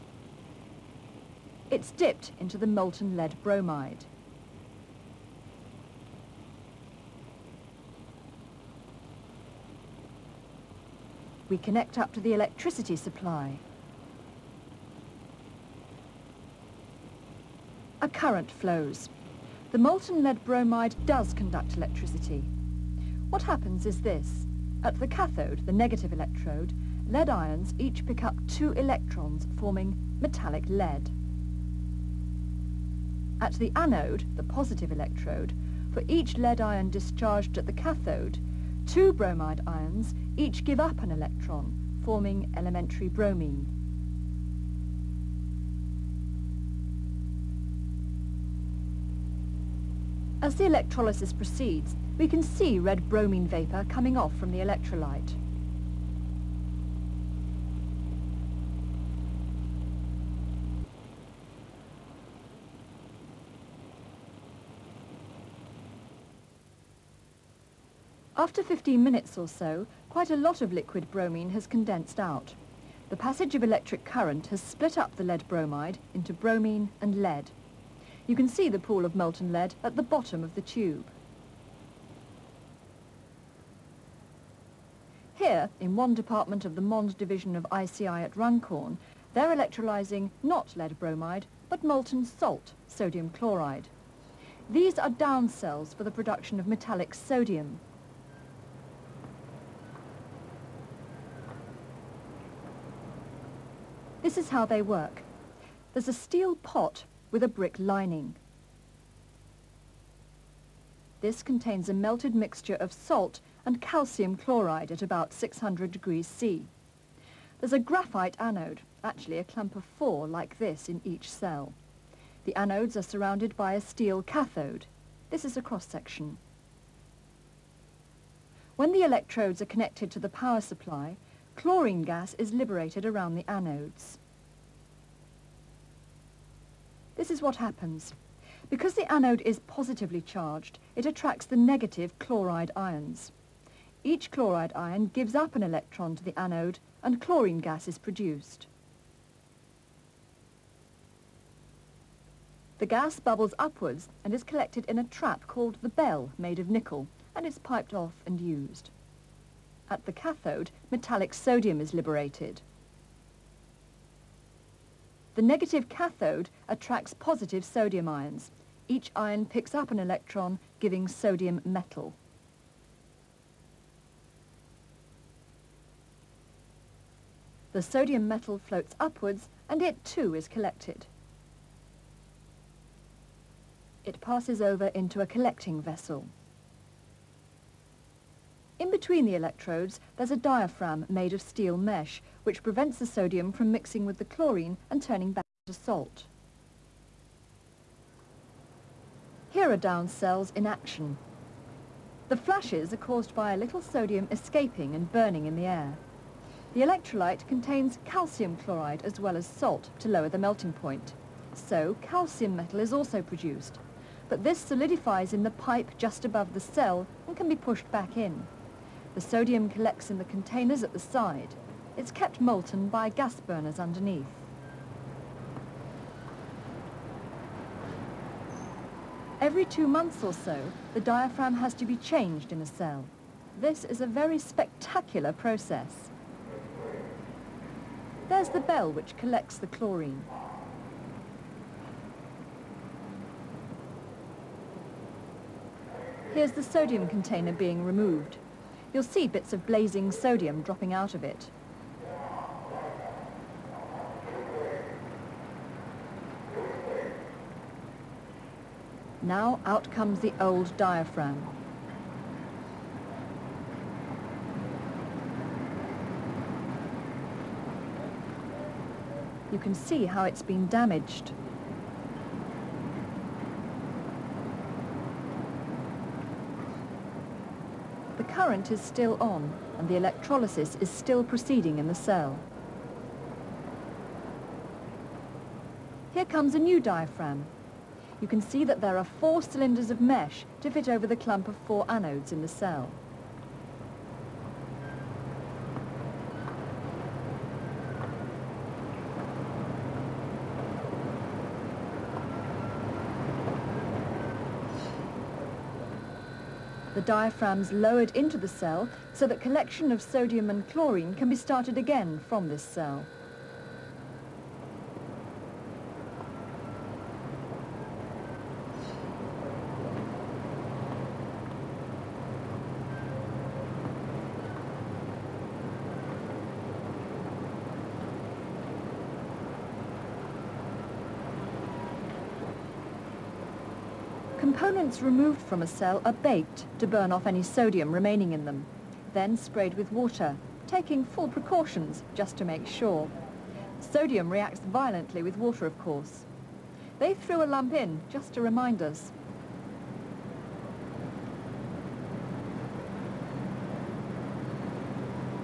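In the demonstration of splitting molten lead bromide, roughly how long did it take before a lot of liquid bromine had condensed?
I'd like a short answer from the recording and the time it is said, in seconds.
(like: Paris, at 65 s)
15 minutes, at 68 s.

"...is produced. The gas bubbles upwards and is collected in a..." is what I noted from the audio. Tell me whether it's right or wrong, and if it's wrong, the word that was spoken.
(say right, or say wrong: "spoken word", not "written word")
right.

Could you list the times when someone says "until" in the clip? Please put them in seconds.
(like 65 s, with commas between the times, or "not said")
not said.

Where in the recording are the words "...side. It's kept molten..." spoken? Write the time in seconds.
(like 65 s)
220 s.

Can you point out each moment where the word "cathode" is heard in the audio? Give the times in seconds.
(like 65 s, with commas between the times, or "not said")
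25 s, 37 s, 124 s, 160 s, 165 s.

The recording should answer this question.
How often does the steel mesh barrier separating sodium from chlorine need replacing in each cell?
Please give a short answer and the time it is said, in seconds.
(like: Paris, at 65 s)
Every 2 months, at 229 s.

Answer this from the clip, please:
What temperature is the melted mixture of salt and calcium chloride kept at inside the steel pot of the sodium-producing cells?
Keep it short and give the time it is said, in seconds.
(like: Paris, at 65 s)
600 degrees C, at 115 s.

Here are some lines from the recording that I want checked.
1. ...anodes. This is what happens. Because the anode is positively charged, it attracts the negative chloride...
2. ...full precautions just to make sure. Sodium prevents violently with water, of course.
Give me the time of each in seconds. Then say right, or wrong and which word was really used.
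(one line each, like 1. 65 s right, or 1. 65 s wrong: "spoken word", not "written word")
1. 133 s right
2. 341 s wrong: "reacts", not "prevents".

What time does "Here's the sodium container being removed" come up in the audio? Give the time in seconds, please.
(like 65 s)
246 s.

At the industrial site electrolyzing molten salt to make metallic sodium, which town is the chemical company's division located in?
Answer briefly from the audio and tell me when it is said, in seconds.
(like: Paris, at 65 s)
Runcorn, at 88 s.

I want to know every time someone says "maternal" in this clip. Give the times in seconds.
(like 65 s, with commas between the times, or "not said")
not said.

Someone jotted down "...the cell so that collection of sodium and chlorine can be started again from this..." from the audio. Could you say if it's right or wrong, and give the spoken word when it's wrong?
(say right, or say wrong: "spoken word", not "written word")
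right.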